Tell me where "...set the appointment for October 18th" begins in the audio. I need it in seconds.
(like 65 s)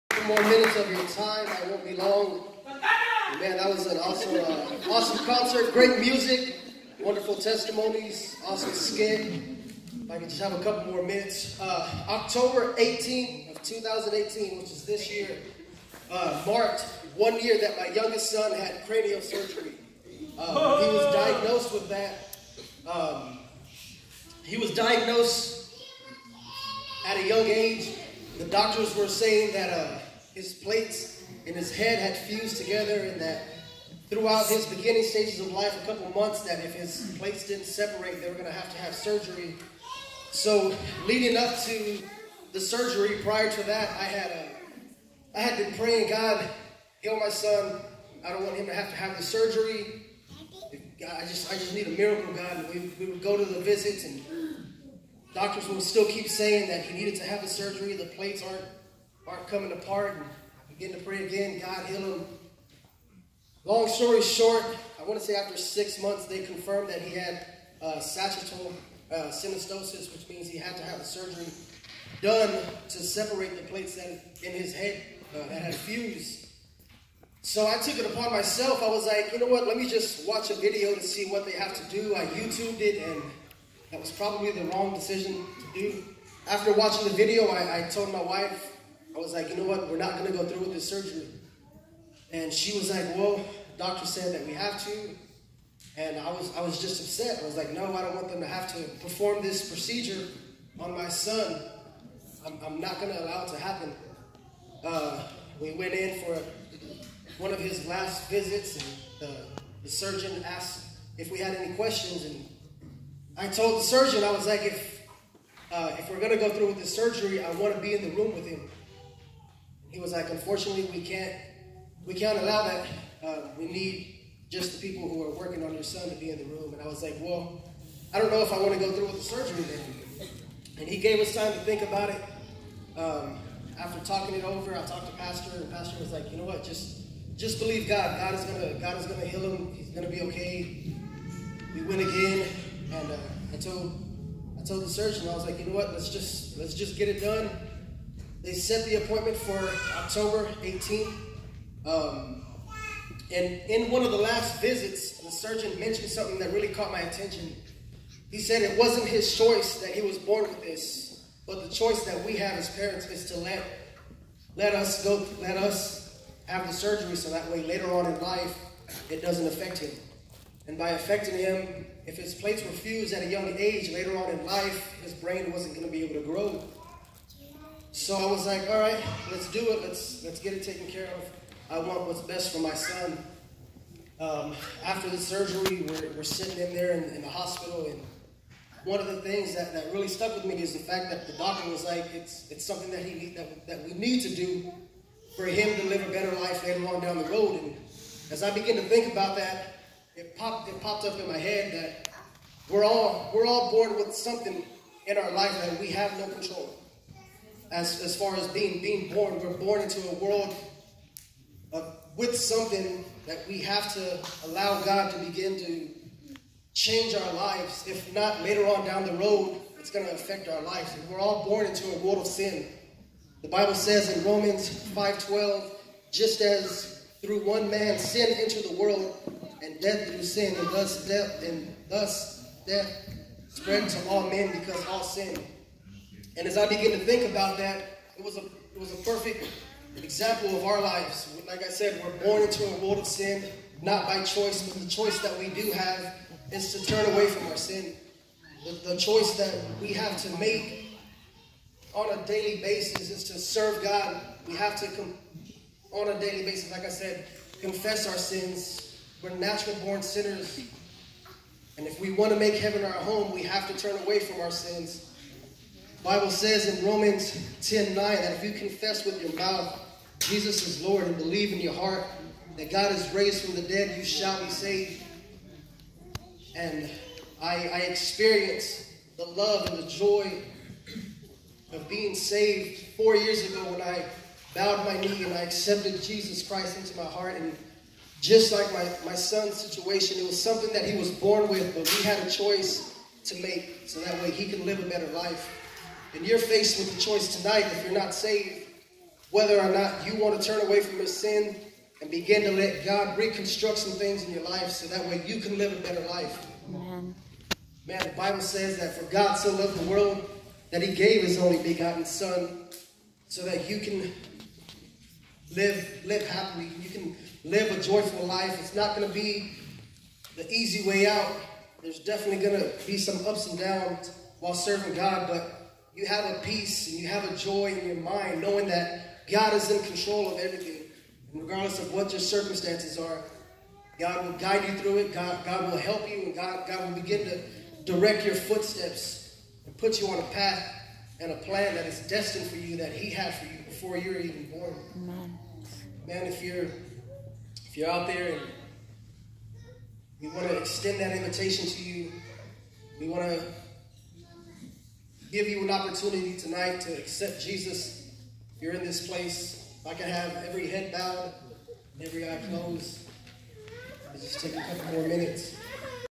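148 s.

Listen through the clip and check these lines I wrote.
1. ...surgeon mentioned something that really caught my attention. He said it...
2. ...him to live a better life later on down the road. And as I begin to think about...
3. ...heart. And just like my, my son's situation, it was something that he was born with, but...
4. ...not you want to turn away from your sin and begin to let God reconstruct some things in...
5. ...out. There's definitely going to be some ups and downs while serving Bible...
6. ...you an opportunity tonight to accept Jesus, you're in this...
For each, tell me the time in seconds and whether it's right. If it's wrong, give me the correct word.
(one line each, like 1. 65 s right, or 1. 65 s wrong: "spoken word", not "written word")
1. 155 s right
2. 195 s right
3. 287 s right
4. 299 s right
5. 321 s wrong: "God", not "Bible"
6. 355 s right.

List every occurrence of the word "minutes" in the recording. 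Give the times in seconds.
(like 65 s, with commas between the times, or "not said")
0 s, 11 s, 365 s.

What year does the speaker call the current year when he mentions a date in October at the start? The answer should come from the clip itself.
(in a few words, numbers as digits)
2018.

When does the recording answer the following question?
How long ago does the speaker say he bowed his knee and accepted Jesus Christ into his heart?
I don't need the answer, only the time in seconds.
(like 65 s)
282 s.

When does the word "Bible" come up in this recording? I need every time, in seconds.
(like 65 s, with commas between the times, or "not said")
223 s, 266 s, 308 s.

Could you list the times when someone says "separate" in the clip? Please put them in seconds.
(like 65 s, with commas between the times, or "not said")
37 s, 72 s.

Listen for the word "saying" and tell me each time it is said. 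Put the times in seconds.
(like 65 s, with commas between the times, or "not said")
29 s, 56 s.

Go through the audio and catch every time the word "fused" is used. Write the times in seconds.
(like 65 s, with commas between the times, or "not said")
32 s, 75 s, 172 s.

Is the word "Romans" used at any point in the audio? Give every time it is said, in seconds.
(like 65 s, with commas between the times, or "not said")
224 s, 266 s.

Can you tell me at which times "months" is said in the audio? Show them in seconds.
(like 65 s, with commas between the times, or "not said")
36 s, 66 s.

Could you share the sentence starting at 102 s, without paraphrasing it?
I'm, I'm not going to allow it to happen.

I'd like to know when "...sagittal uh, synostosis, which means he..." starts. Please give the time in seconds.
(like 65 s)
67 s.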